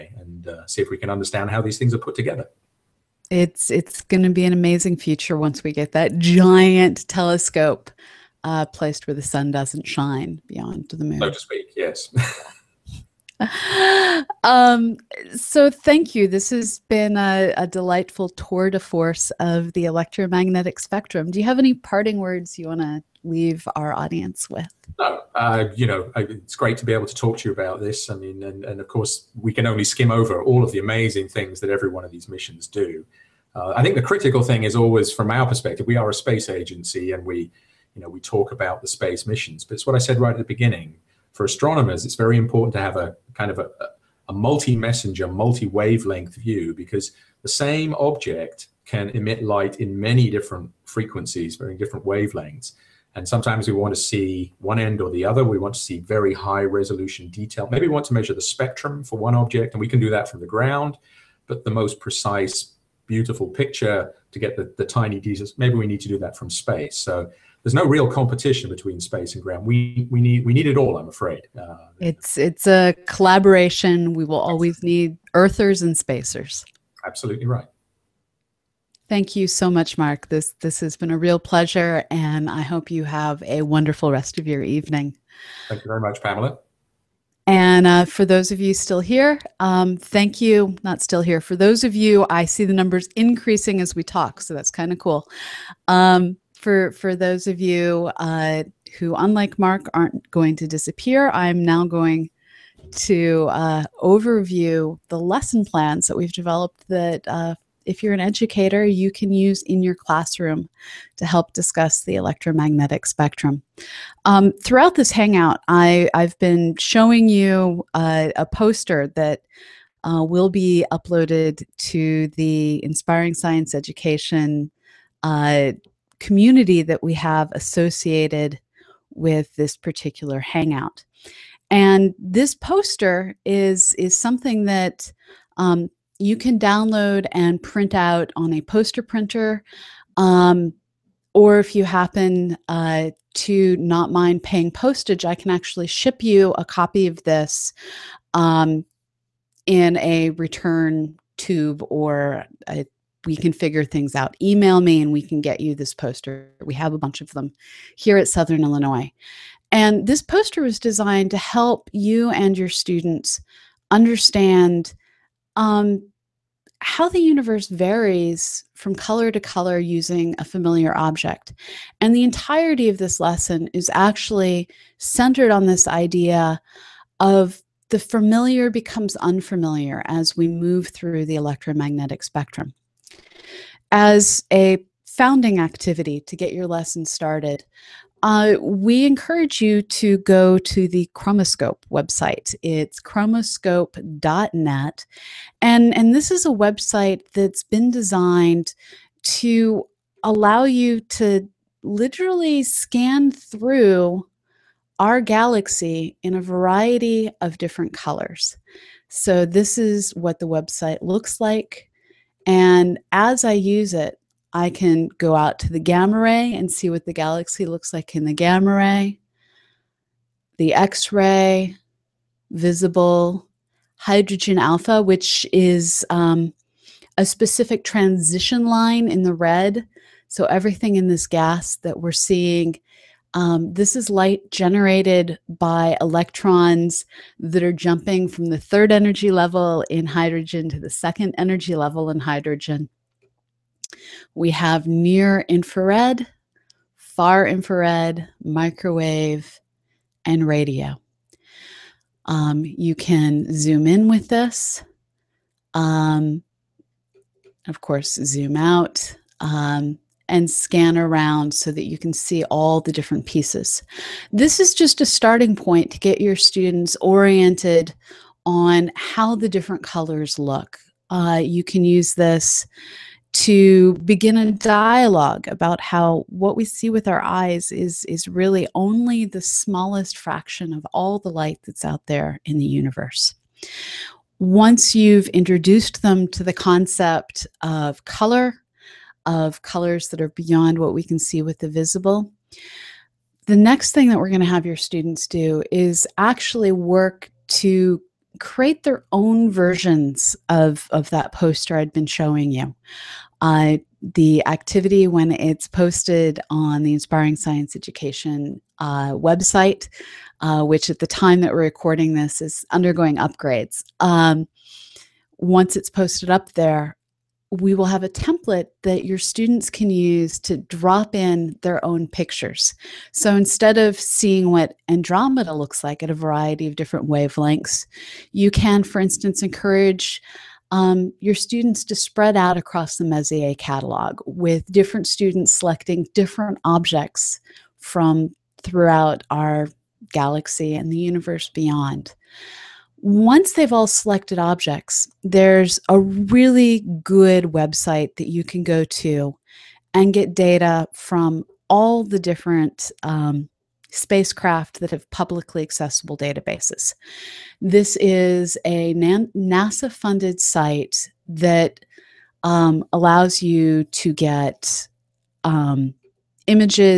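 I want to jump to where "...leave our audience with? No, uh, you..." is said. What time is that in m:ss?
0:23.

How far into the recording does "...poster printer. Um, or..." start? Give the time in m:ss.
2:18.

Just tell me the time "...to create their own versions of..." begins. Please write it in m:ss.
4:57.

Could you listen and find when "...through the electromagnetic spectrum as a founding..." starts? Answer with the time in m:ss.
3:00.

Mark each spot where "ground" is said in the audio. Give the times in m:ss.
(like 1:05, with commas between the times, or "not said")
1:00, 1:09.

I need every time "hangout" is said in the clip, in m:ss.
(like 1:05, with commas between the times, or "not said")
1:55, 2:10.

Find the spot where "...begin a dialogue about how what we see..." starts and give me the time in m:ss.
4:34.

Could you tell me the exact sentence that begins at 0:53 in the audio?
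And sometimes we want to see one end or the other.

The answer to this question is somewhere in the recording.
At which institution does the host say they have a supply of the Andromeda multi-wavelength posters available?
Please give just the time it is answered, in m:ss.
2:38.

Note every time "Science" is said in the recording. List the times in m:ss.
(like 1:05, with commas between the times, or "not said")
2:03, 5:07.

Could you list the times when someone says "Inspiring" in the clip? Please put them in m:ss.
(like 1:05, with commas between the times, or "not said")
2:02, 5:06.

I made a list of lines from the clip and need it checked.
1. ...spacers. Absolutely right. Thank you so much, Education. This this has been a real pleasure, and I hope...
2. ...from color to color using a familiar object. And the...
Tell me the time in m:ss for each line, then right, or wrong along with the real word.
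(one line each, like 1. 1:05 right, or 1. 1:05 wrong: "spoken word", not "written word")
1. 1:15 wrong: "Mark", not "Education"
2. 2:48 right.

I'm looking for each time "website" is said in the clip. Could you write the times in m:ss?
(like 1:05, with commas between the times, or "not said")
3:11, 3:16, 3:30, 5:09, 5:47.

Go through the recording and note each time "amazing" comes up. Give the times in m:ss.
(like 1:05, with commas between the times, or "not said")
0:04, 0:30.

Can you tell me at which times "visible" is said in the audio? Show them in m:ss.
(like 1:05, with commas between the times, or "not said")
3:42, 4:51.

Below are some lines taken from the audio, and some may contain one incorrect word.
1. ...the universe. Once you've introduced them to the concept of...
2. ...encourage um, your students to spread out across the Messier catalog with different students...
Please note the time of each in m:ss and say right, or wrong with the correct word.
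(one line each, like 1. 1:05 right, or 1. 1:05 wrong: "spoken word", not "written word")
1. 4:42 right
2. 5:29 right.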